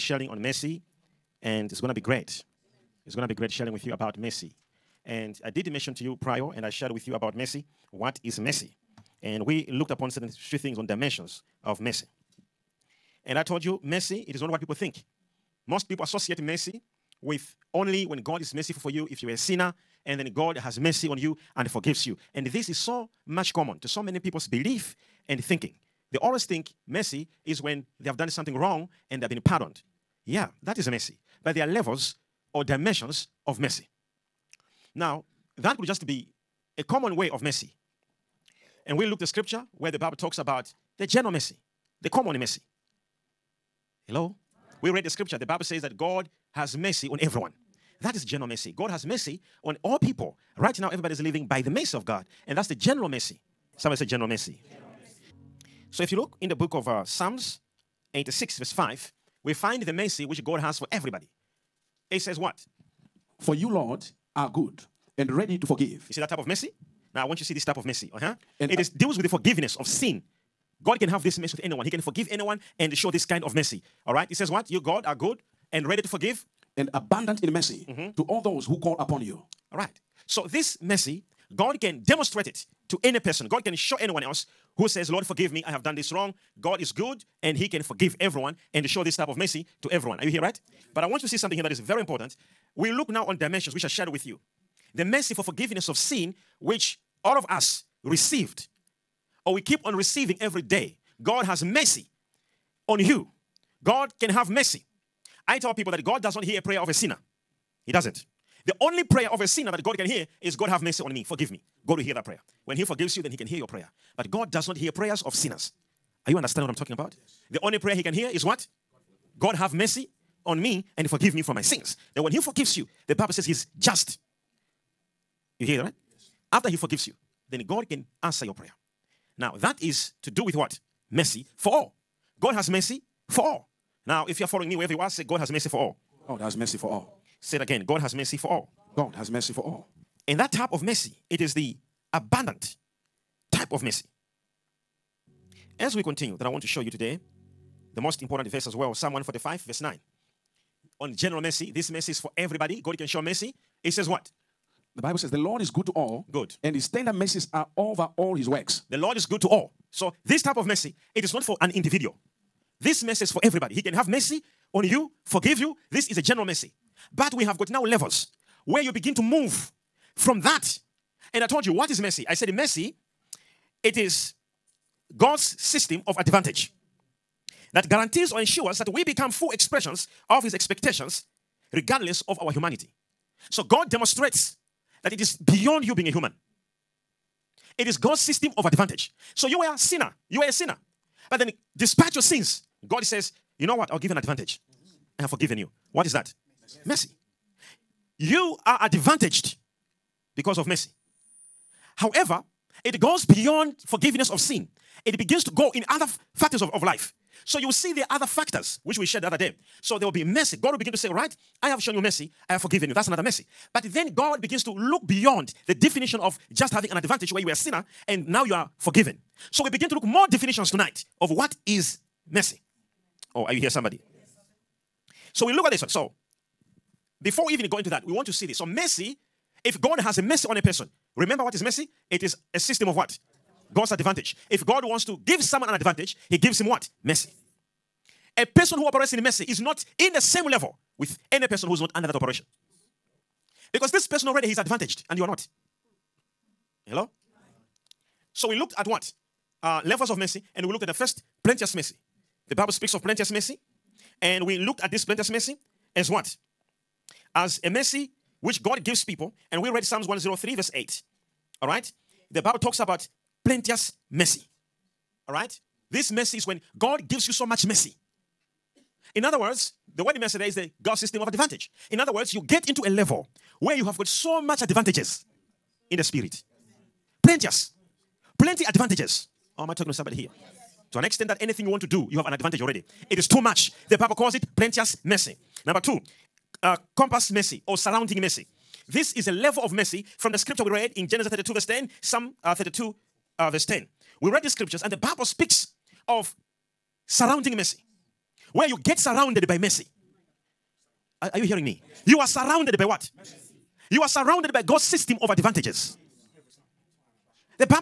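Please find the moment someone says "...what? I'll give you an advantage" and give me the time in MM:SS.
03:13.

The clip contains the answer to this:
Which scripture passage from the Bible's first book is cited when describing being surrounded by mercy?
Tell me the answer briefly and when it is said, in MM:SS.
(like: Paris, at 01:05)
Genesis 32:10, at 04:51.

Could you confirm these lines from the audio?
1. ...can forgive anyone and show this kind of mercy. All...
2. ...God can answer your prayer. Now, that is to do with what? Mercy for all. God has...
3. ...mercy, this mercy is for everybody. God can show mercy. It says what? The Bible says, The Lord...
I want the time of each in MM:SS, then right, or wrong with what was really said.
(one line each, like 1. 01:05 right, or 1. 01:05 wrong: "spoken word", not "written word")
1. 01:11 right
2. 02:07 right
3. 02:31 right.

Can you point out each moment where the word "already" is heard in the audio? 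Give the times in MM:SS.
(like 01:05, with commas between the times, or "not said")
04:04, 04:42.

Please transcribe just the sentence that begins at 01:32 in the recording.
We look now on dimensions which I shared with you.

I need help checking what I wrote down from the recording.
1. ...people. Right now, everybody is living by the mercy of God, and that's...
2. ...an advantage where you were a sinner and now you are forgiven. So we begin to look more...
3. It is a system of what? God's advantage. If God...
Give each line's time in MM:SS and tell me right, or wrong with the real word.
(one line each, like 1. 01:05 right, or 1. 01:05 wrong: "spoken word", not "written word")
1. 00:49 right
2. 03:36 right
3. 03:52 right.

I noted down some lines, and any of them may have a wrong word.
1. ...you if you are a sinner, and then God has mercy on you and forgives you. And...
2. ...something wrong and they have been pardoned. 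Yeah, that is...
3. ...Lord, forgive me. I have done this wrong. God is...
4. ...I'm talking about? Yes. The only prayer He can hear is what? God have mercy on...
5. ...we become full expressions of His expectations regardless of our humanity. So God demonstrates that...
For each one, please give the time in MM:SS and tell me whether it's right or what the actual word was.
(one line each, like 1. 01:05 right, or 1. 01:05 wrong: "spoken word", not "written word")
1. 00:18 right
2. 00:28 right
3. 01:25 right
4. 01:56 right
5. 02:58 right.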